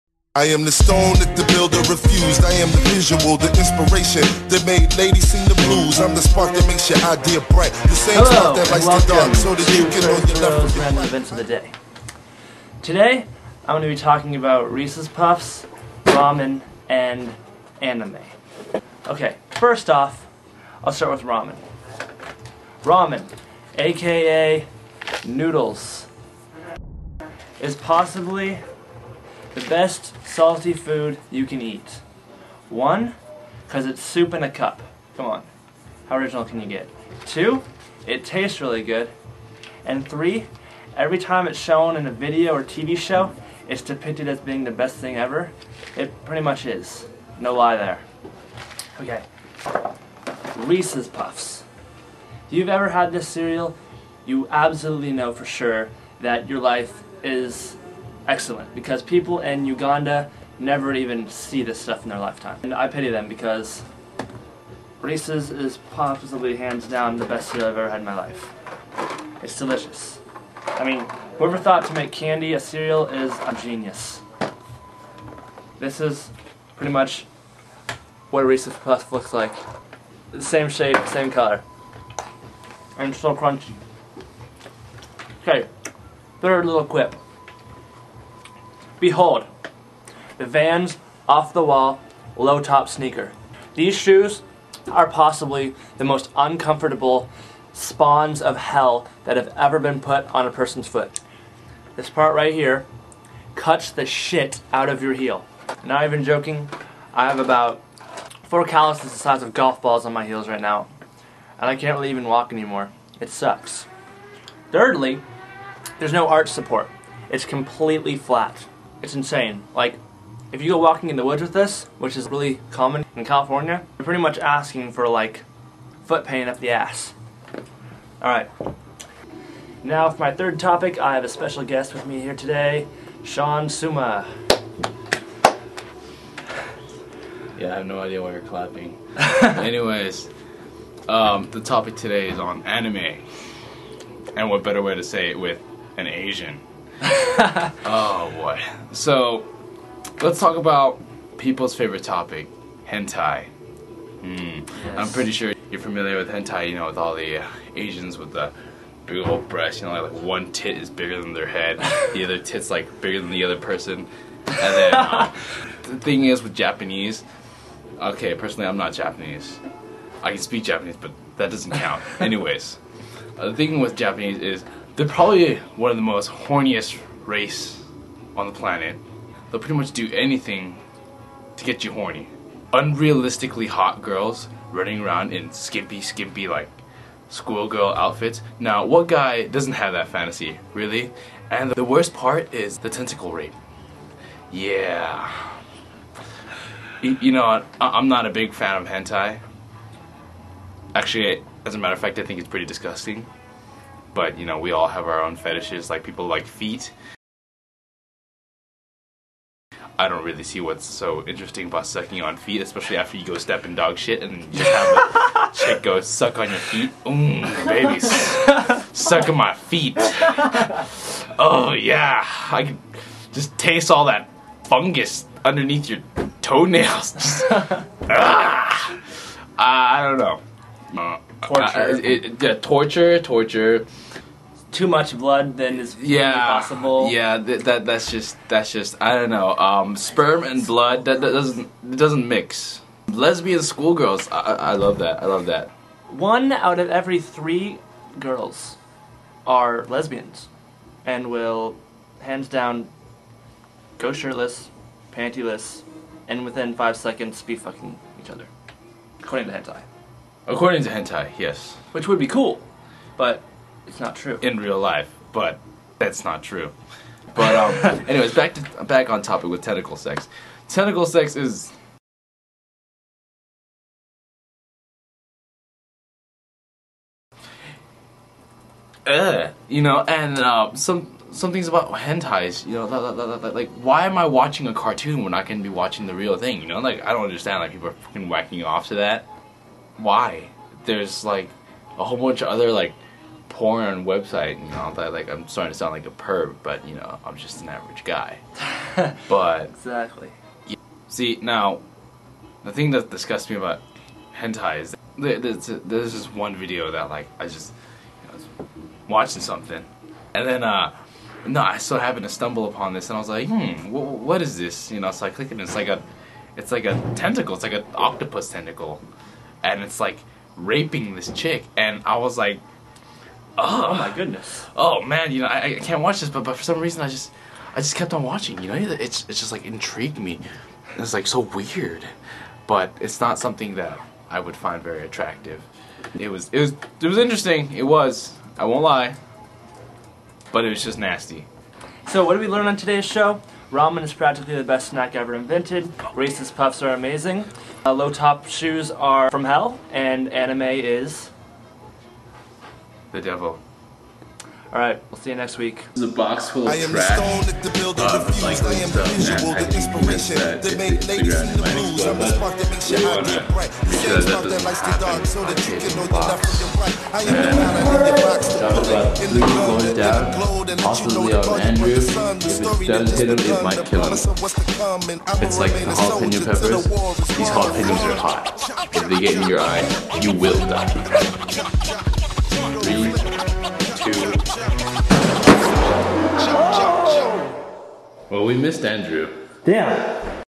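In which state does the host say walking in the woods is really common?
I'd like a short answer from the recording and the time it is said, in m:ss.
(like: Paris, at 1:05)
California, at 2:03.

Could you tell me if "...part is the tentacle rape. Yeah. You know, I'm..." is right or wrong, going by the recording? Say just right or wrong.
right.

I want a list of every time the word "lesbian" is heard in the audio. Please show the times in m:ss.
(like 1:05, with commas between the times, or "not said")
4:03, 4:09.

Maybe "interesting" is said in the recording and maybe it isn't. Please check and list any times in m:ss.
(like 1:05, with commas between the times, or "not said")
3:31, 5:37.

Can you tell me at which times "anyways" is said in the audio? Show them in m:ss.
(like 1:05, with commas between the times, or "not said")
2:19, 2:52, 4:28.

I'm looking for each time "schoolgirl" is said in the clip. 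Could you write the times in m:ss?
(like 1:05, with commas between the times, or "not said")
3:07, 4:03.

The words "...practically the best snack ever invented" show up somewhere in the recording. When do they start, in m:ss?
5:44.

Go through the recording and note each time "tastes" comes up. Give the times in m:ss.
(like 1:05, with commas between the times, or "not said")
0:38, 3:43.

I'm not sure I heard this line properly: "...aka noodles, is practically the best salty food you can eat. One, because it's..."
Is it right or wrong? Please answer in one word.
wrong.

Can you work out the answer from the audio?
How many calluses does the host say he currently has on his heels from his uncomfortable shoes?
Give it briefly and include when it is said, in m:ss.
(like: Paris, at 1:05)
4, at 1:48.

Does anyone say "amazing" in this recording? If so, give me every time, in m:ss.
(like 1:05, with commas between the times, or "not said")
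5:46.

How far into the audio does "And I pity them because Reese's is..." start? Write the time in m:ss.
1:02.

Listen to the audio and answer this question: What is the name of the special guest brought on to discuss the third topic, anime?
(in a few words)
Sean Suma.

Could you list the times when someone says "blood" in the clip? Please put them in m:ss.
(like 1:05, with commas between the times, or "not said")
3:55, 4:00.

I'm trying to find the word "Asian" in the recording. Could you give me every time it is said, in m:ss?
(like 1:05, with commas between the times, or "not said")
2:26, 2:37.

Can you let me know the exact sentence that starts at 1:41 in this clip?
This part right here cuts the shit out of your heel.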